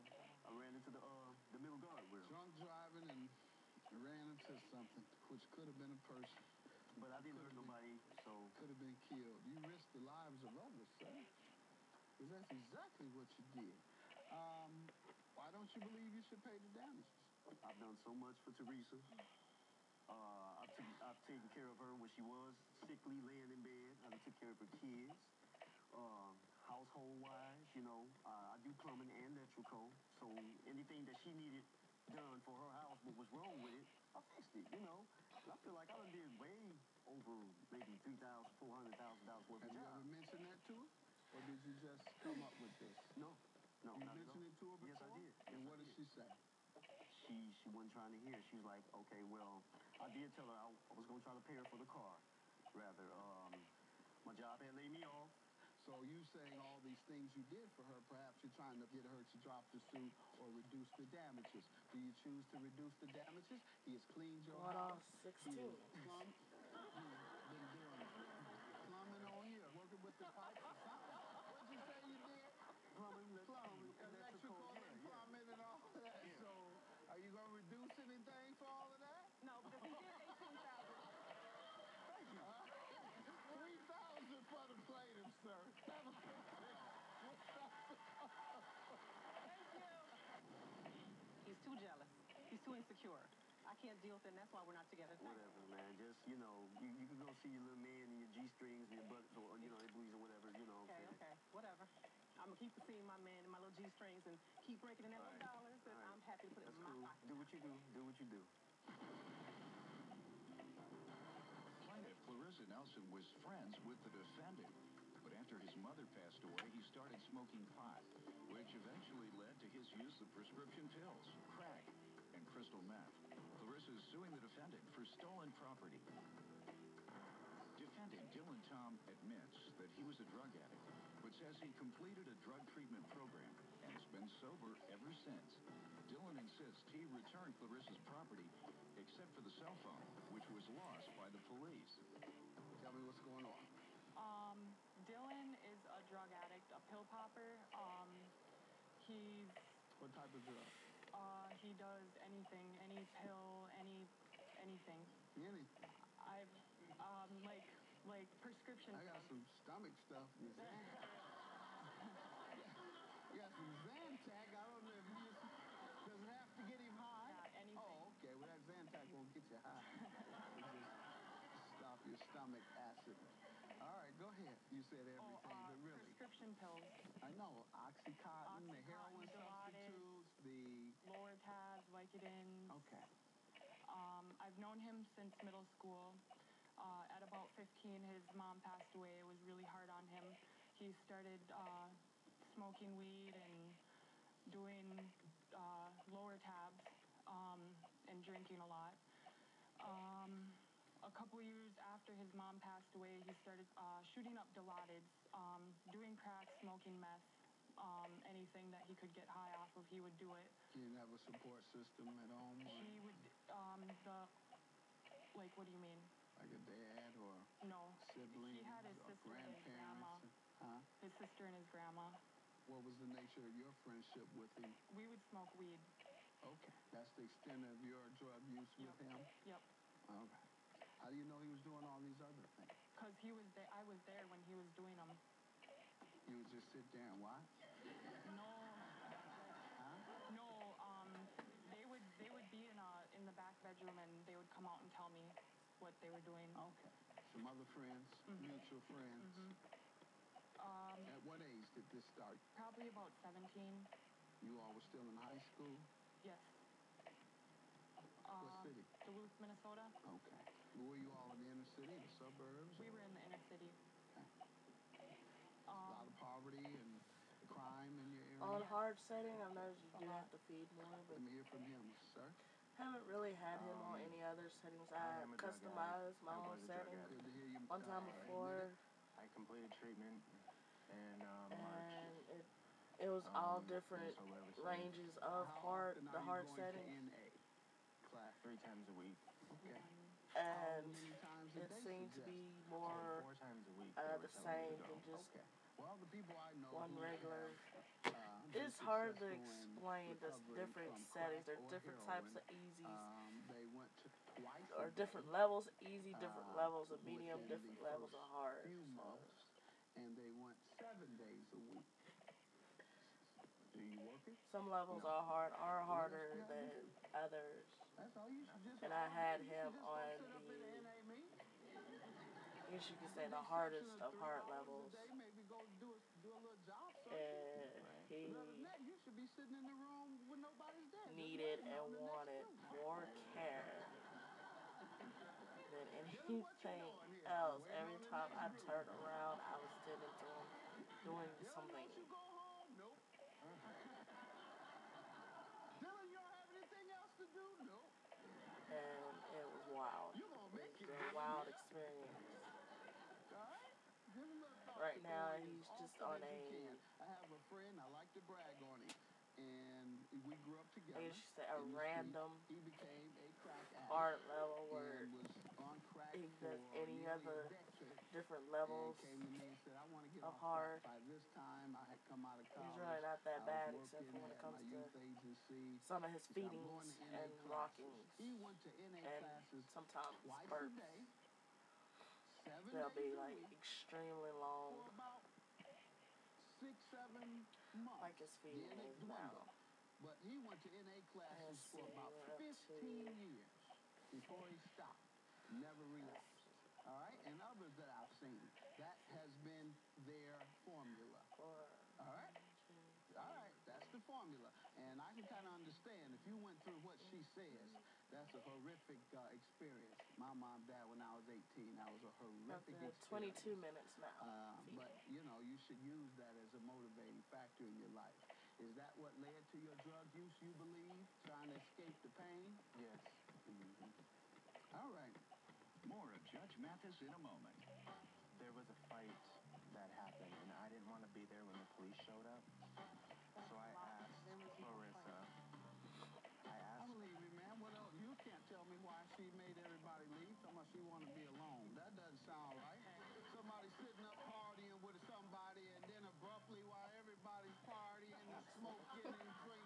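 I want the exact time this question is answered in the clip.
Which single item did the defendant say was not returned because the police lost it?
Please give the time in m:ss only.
2:19.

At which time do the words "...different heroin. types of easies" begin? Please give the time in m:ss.
5:01.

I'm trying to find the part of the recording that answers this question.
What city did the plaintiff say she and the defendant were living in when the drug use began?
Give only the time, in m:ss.
4:19.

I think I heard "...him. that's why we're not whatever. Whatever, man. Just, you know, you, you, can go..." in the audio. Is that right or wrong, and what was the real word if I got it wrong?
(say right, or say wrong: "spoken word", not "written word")
wrong: "together", not "whatever".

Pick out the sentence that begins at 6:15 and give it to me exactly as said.
some of his feedings and rockings.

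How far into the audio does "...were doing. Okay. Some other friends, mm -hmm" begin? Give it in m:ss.
4:06.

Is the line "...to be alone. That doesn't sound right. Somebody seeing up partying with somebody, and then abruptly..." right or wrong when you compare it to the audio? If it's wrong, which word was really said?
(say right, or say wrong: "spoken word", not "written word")
wrong: "sitting", not "seeing".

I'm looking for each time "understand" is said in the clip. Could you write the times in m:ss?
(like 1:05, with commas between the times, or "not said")
6:45.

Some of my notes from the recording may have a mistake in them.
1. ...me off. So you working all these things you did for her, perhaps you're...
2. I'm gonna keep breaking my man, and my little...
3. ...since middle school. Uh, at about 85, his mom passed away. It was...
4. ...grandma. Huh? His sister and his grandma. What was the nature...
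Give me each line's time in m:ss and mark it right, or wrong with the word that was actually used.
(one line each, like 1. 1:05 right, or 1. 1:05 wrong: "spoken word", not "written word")
1. 0:54 wrong: "saying", not "working"
2. 1:42 wrong: "seeing", not "breaking"
3. 3:05 wrong: "15", not "85"
4. 3:39 right.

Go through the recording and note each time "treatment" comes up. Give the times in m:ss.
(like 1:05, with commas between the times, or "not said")
2:12, 4:39.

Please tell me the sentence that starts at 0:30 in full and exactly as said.
So anything that she needed done for her house, what was wrong with it, I fixed it, you know.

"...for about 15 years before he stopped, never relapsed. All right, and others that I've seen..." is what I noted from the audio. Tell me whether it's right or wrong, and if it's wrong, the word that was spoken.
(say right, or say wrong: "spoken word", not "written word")
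right.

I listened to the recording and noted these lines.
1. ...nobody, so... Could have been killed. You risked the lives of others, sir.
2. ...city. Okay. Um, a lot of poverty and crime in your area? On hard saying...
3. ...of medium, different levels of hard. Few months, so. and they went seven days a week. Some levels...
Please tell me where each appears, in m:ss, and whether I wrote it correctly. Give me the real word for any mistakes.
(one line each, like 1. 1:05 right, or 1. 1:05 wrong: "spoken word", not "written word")
1. 0:07 right
2. 4:23 wrong: "setting", not "saying"
3. 5:06 right.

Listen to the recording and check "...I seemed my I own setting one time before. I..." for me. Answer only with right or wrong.
wrong.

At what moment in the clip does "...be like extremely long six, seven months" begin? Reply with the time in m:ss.
6:22.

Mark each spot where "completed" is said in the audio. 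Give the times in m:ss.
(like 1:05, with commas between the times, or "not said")
2:11, 4:39.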